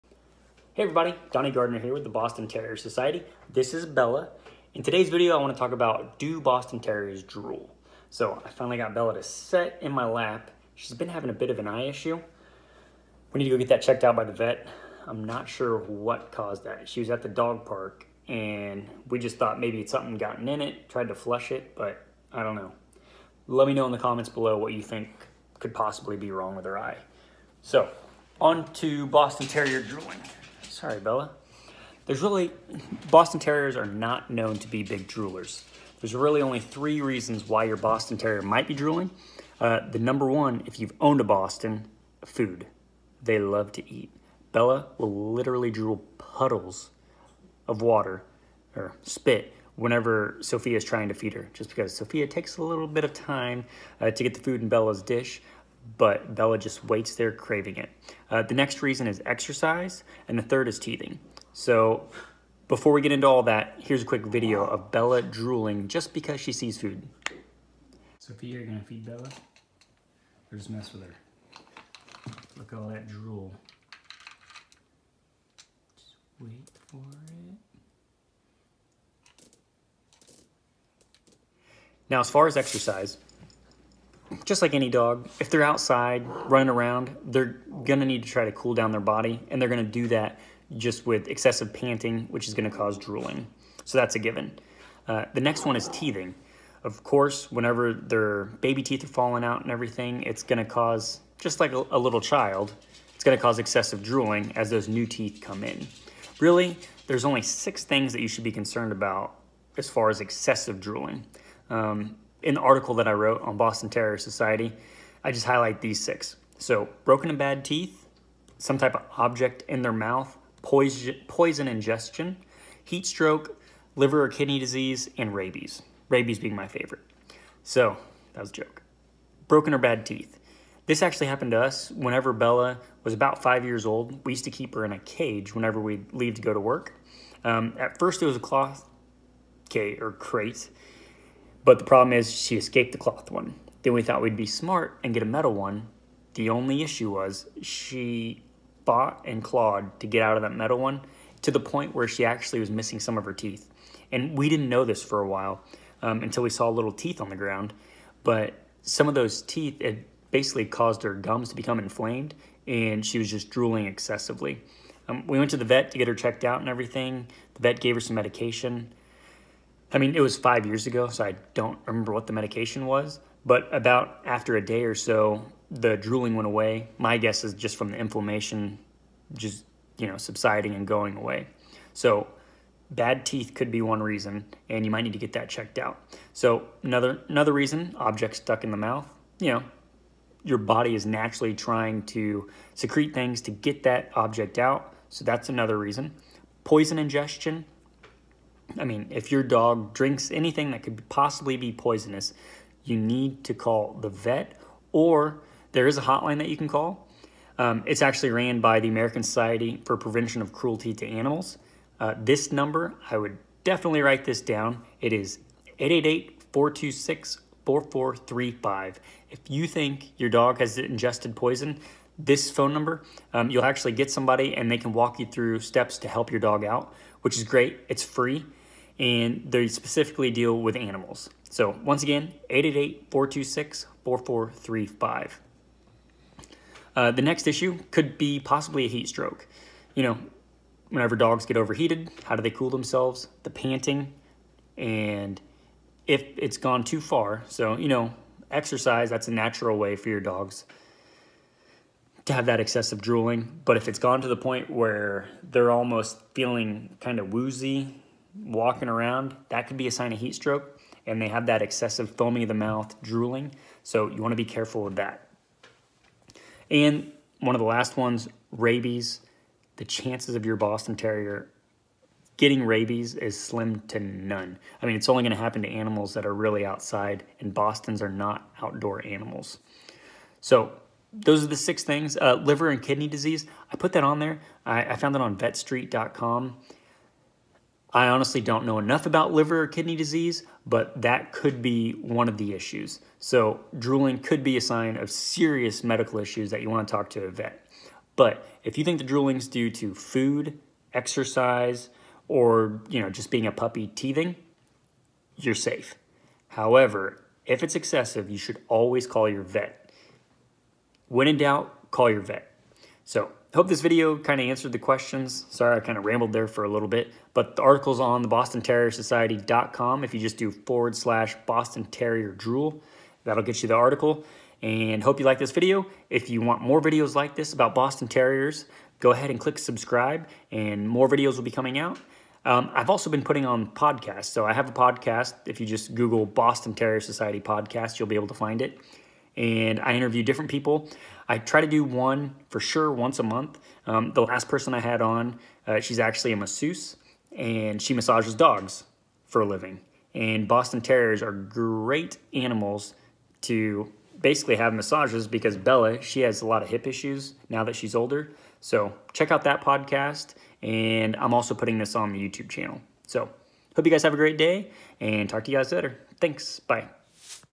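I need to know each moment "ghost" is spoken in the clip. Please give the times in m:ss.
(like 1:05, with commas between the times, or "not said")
not said.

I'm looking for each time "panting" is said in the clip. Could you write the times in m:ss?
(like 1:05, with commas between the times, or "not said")
1:31, 4:03.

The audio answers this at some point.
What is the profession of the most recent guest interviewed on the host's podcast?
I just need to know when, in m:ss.
5:46.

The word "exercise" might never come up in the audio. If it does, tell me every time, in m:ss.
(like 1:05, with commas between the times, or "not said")
0:59, 1:22, 4:08, 5:00.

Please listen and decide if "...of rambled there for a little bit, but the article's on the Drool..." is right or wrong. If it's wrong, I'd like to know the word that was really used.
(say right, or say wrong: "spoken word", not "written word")
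wrong: "Boston", not "Drool".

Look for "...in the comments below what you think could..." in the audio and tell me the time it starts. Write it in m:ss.
0:23.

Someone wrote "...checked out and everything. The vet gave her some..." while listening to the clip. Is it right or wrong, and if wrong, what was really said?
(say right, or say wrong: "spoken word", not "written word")
right.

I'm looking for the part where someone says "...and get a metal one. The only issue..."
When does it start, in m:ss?
2:25.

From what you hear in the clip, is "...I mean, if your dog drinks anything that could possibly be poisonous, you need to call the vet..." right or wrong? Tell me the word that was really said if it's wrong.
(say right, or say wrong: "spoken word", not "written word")
right.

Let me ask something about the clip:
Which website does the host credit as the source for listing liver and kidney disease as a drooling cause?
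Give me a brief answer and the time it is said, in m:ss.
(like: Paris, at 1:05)
vetstreet.com, at 4:45.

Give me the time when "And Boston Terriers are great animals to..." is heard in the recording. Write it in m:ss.
5:50.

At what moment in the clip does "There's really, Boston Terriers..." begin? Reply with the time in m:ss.
0:32.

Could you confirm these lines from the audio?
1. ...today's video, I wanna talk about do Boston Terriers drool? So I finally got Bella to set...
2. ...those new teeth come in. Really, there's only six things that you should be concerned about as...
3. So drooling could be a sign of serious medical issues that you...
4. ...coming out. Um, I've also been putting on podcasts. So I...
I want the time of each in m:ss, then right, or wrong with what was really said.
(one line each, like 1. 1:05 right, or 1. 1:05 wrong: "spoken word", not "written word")
1. 0:04 right
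2. 1:44 right
3. 4:53 right
4. 5:31 right.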